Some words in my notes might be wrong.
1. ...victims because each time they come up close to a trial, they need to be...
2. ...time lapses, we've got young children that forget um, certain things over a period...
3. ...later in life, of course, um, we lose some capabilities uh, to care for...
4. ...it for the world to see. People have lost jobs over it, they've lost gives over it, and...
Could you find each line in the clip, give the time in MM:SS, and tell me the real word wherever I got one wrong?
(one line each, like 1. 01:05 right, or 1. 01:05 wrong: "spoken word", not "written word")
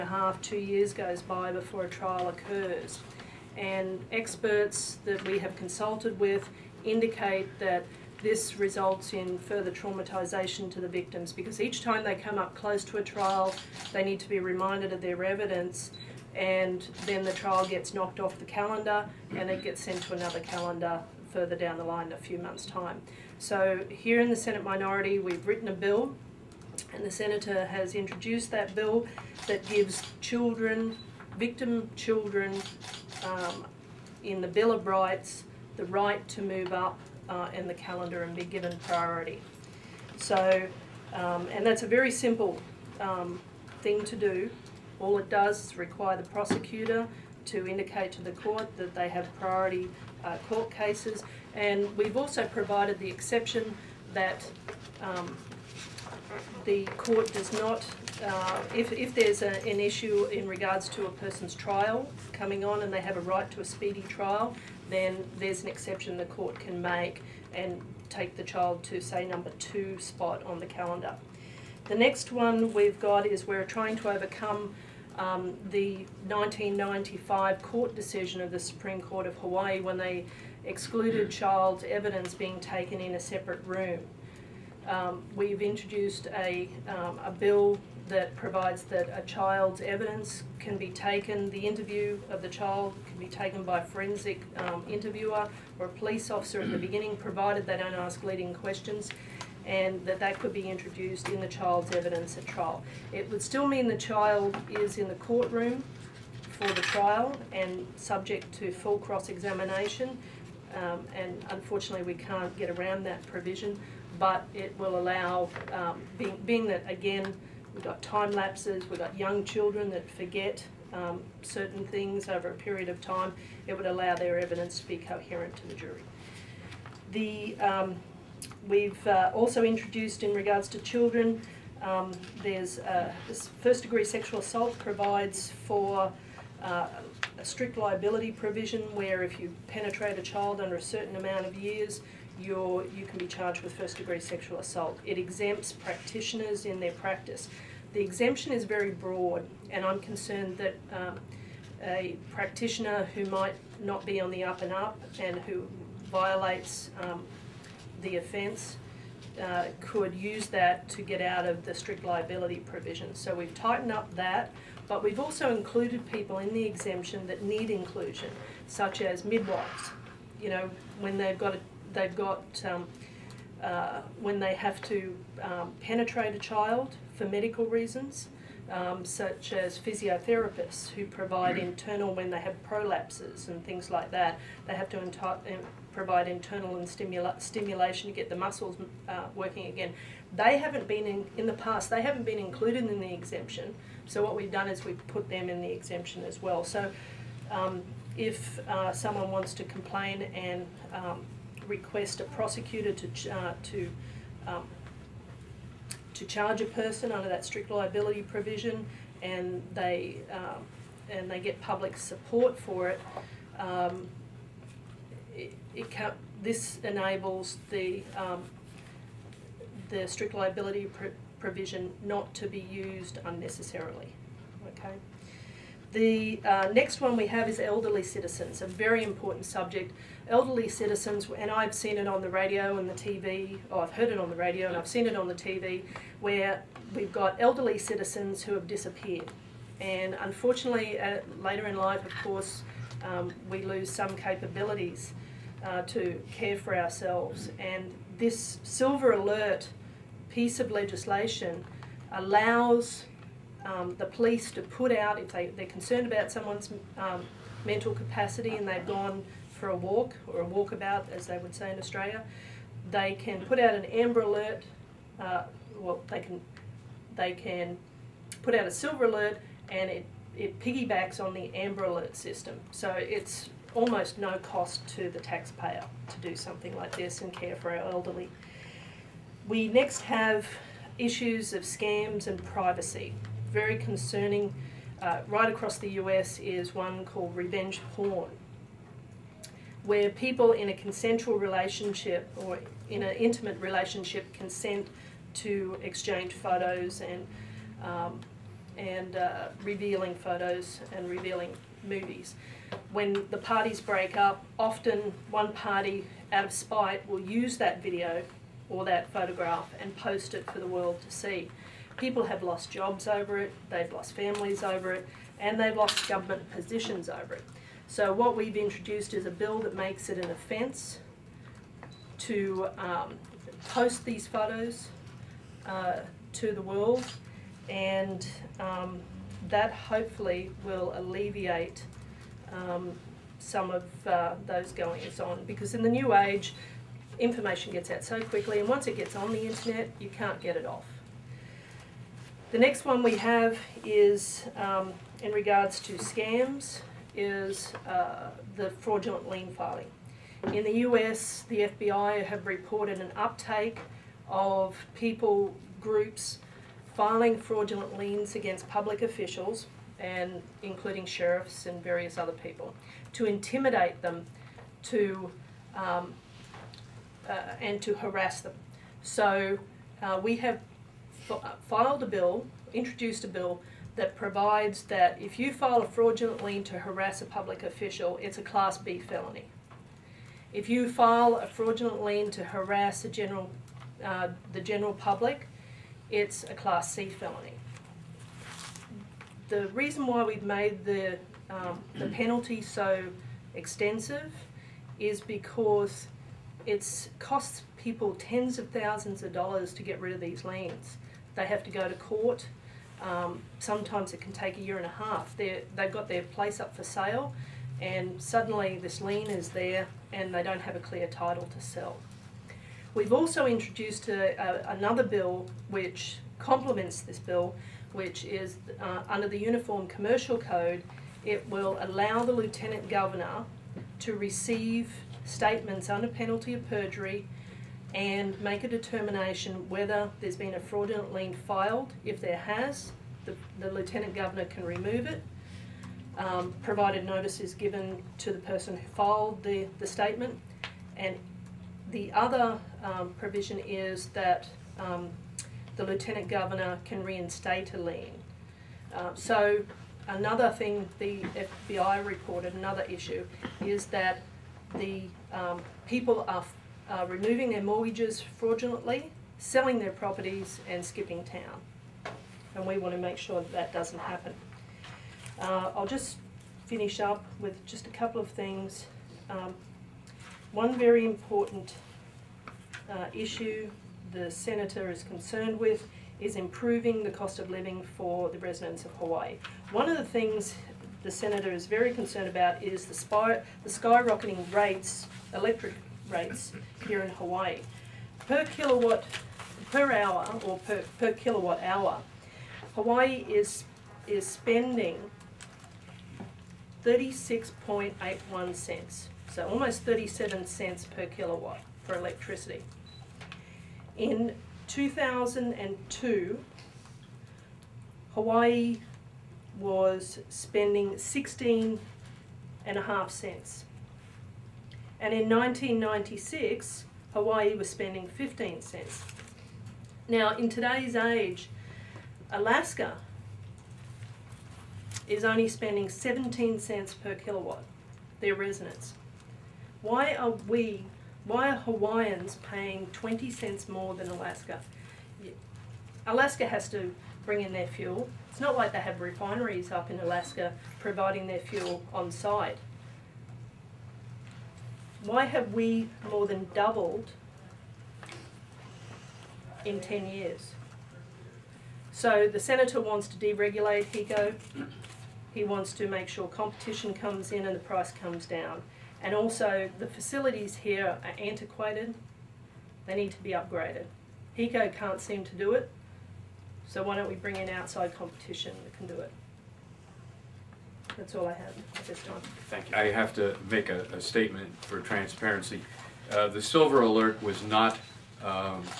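1. 00:10 right
2. 01:58 right
3. 04:01 right
4. 05:10 wrong: "families", not "gives".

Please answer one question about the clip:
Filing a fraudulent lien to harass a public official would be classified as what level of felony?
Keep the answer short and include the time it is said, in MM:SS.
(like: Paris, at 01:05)
Class B felony, at 06:18.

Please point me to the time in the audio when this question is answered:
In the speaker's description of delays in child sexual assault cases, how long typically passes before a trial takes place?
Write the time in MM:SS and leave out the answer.
00:00.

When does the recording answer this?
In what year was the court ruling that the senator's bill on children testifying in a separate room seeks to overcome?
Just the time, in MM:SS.
01:16.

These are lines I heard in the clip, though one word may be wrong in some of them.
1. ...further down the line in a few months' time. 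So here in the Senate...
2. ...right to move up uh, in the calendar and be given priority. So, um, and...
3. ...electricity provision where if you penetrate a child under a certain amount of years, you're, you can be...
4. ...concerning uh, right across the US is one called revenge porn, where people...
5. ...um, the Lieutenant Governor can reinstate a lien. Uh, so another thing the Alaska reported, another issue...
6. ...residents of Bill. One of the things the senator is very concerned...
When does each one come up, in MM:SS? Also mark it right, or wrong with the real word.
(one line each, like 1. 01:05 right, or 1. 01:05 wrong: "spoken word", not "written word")
1. 00:21 right
2. 00:35 right
3. 02:17 wrong: "liability", not "electricity"
4. 04:43 right
5. 07:24 wrong: "FBI", not "Alaska"
6. 07:58 wrong: "Hawaii", not "Bill".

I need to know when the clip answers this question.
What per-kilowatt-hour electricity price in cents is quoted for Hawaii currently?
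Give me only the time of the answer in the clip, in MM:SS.
08:16.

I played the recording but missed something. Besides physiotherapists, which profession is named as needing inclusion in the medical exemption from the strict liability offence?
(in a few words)
Midwives.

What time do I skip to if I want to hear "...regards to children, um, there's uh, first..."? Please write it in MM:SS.
02:10.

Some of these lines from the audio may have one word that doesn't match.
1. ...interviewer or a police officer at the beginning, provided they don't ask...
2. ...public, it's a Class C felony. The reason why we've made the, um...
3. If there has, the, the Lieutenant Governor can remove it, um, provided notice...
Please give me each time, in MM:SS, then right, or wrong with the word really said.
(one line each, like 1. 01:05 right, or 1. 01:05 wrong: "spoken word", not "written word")
1. 01:34 right
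2. 06:24 right
3. 07:12 right.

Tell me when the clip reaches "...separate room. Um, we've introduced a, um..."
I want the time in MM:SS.
01:23.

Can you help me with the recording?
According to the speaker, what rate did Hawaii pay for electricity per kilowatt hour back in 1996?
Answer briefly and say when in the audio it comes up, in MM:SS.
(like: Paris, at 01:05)
15 cents, at 08:38.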